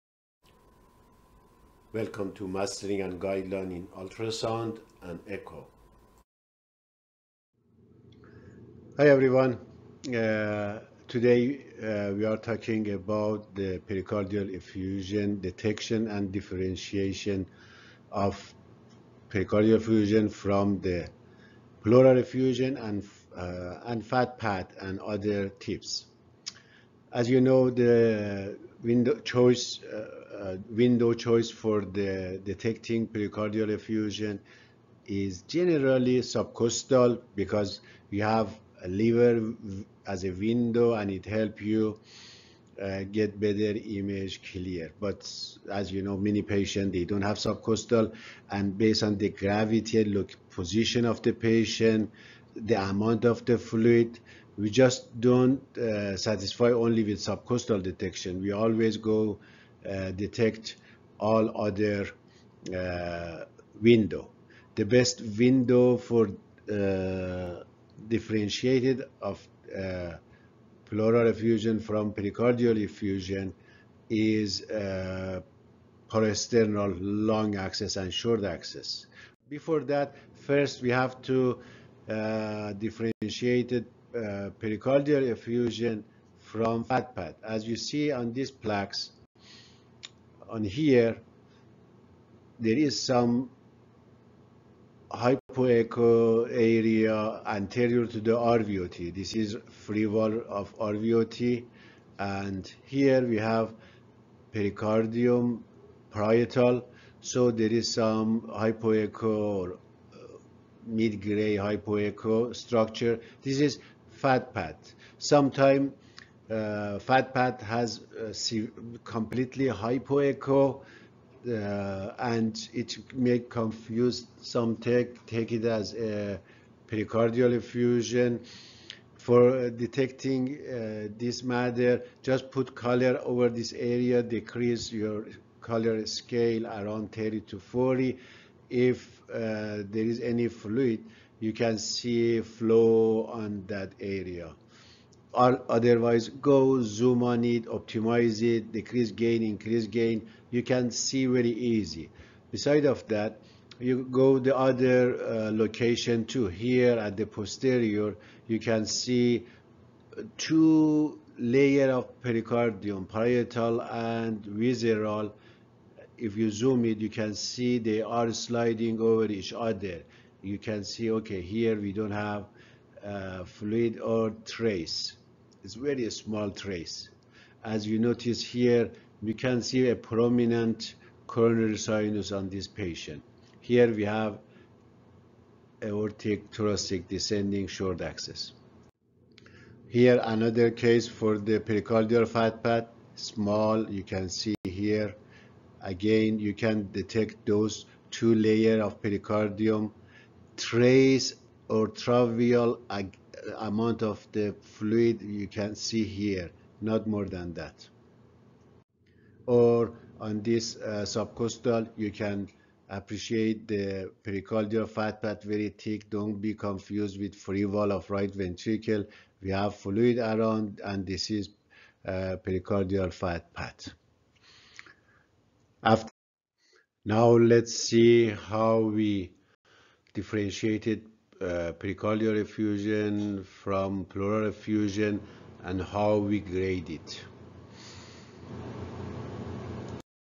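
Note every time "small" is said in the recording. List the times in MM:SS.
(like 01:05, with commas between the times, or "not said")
02:56, 03:13.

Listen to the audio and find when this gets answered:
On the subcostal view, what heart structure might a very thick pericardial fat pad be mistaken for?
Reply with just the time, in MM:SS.
03:37.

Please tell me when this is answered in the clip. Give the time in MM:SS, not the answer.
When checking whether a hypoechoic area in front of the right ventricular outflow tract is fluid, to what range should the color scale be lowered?
02:17.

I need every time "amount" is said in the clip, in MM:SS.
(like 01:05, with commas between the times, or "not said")
00:52, 03:23.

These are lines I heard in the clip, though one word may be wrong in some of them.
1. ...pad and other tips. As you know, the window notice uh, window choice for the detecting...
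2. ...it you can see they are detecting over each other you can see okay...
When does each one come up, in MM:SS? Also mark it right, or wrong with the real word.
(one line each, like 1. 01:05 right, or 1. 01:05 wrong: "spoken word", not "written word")
1. 00:24 wrong: "choice", not "notice"
2. 02:46 wrong: "sliding", not "detecting".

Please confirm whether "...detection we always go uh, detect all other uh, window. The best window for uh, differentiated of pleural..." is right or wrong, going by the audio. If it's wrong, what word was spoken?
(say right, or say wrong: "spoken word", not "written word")
right.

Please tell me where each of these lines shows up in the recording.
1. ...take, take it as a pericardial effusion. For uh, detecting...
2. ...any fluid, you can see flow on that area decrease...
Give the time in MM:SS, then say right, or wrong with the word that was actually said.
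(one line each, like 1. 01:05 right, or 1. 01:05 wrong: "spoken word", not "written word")
1. 02:04 right
2. 02:20 wrong: "otherwise", not "decrease".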